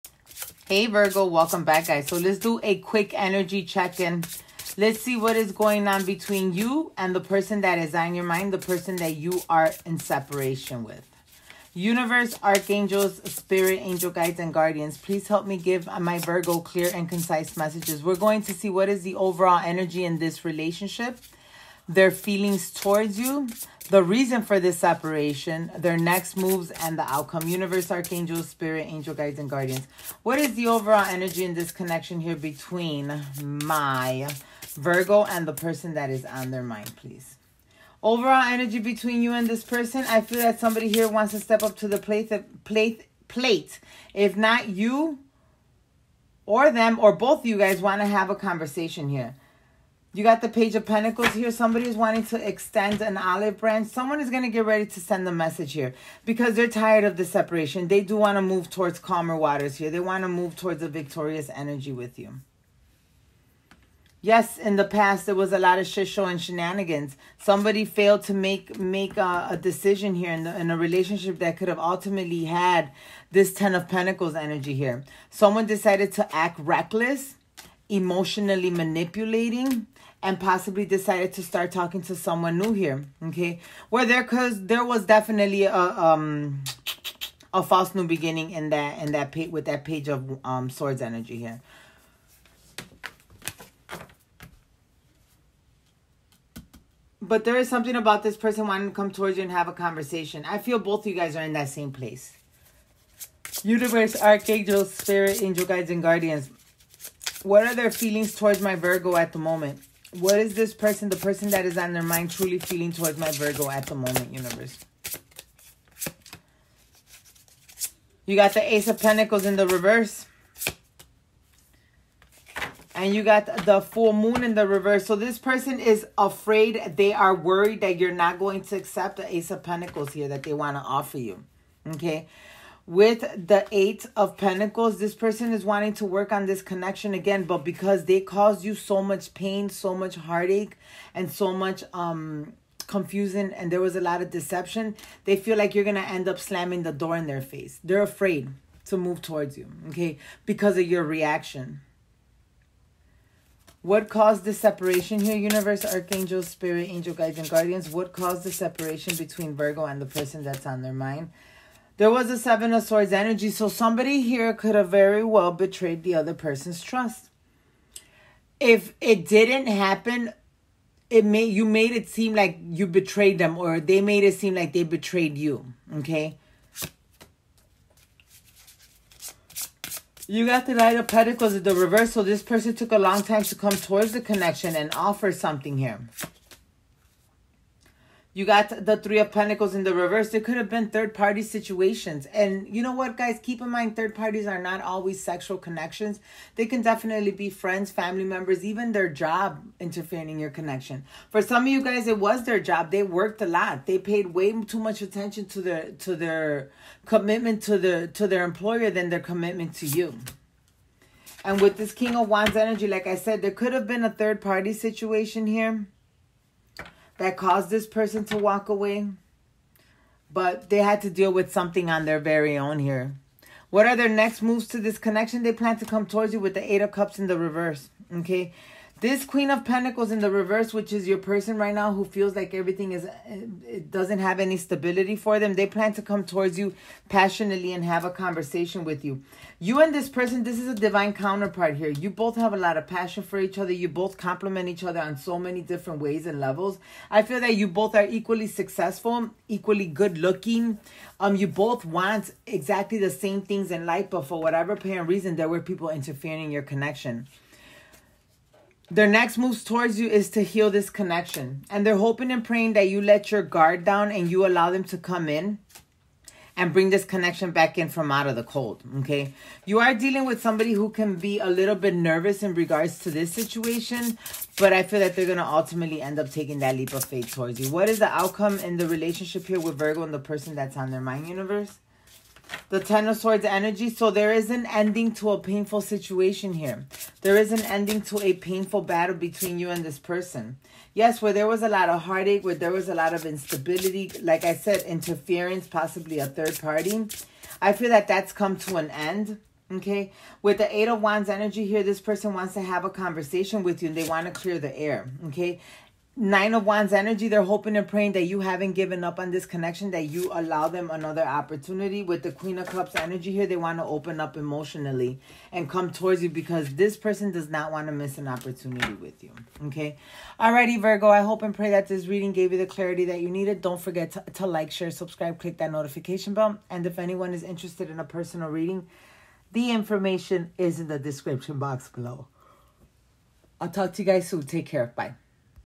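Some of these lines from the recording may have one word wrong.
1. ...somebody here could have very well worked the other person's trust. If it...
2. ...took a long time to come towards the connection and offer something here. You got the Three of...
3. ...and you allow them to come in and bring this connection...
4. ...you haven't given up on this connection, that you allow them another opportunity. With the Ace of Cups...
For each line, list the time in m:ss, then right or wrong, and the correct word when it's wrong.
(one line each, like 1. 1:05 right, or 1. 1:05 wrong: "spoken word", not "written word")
1. 2:43 wrong: "betrayed", not "worked"
2. 3:02 right
3. 4:24 right
4. 5:08 wrong: "Queen", not "Ace".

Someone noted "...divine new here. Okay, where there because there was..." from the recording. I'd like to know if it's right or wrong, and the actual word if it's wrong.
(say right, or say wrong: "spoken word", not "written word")
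wrong: "someone", not "divine".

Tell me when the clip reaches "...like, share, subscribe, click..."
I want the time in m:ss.
5:24.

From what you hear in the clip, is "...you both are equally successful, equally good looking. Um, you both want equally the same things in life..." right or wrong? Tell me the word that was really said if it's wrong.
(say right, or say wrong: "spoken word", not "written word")
wrong: "exactly", not "equally".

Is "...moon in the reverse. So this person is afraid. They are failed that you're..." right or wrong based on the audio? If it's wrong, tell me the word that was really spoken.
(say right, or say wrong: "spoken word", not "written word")
wrong: "worried", not "failed".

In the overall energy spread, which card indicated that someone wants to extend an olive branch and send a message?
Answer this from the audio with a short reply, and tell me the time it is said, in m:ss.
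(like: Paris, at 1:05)
Page of Pentacles, at 0:50.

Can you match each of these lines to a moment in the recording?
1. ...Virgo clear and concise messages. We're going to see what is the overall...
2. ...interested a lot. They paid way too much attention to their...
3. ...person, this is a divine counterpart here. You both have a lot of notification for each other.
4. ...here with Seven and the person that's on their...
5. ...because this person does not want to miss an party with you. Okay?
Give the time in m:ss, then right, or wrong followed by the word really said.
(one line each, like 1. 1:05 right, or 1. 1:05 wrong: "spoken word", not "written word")
1. 0:16 right
2. 3:23 wrong: "worked", not "interested"
3. 4:00 wrong: "passion", not "notification"
4. 4:39 wrong: "Virgo", not "Seven"
5. 5:16 wrong: "opportunity", not "party".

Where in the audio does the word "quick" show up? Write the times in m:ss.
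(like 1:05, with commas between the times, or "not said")
0:02.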